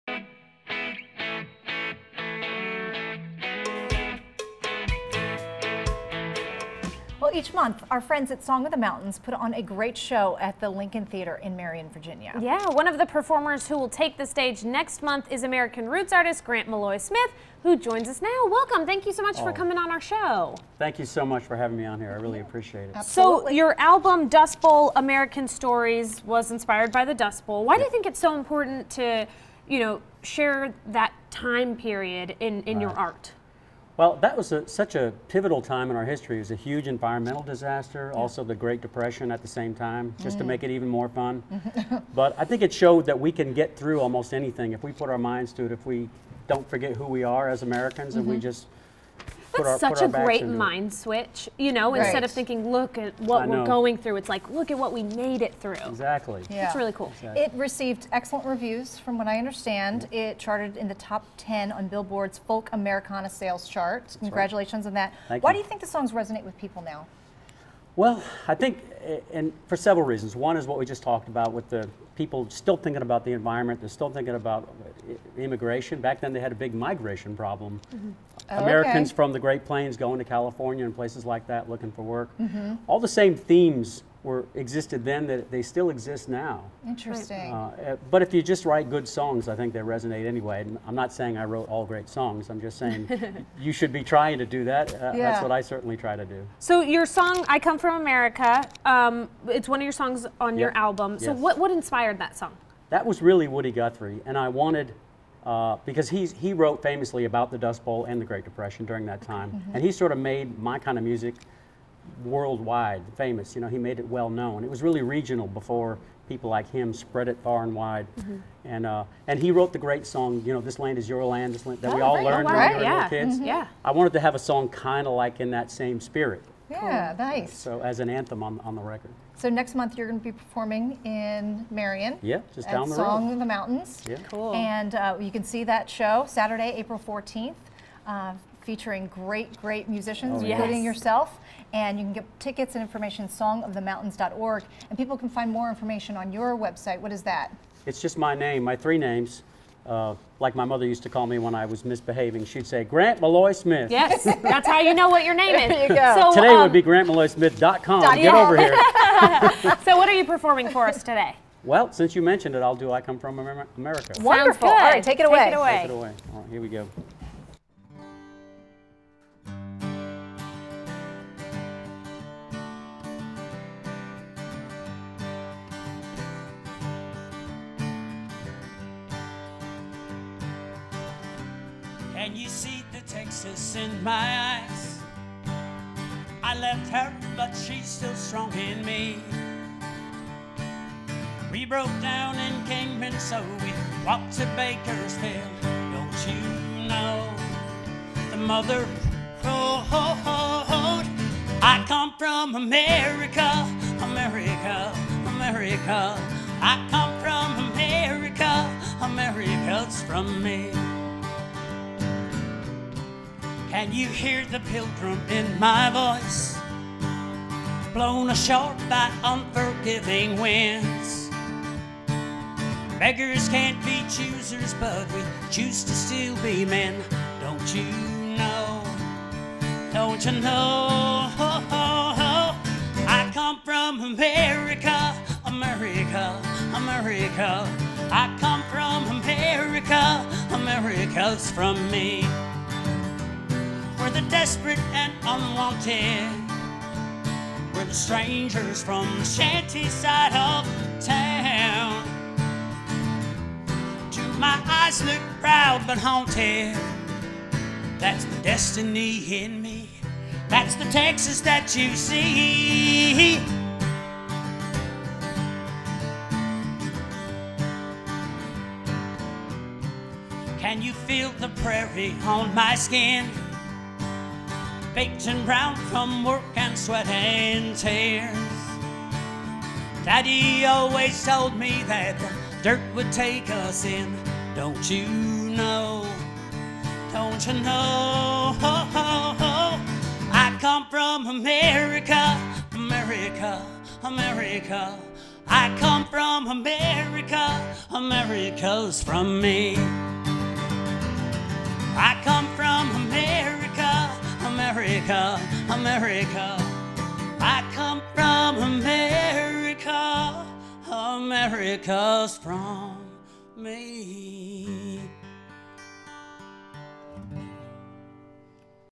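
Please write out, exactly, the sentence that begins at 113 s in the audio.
You know, he made it well known.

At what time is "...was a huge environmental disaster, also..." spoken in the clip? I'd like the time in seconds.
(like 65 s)
36 s.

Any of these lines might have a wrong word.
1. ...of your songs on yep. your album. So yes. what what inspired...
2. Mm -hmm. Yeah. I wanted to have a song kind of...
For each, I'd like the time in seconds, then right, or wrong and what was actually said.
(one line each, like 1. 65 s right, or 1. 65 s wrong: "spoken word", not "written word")
1. 99 s right
2. 123 s right.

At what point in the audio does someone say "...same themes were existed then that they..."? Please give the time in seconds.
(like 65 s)
83 s.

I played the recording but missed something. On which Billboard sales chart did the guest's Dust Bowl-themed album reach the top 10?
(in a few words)
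Folk Americana.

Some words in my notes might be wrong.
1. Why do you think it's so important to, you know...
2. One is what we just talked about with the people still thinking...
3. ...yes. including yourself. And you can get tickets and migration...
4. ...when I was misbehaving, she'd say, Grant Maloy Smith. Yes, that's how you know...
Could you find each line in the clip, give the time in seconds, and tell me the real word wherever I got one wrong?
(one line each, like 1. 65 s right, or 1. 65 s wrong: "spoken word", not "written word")
1. 27 s right
2. 70 s right
3. 140 s wrong: "information", not "migration"
4. 151 s right.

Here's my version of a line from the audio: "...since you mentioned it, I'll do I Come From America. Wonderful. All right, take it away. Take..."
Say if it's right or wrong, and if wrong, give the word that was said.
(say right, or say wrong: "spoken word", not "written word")
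right.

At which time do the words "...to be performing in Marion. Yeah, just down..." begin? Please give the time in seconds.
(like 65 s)
130 s.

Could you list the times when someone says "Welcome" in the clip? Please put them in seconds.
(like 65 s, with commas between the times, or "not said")
18 s.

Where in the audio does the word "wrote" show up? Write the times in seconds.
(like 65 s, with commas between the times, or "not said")
91 s, 106 s, 119 s.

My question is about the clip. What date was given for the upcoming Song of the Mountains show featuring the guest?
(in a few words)
Saturday, April 14th.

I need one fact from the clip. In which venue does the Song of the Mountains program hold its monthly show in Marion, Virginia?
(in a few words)
Lincoln Theater.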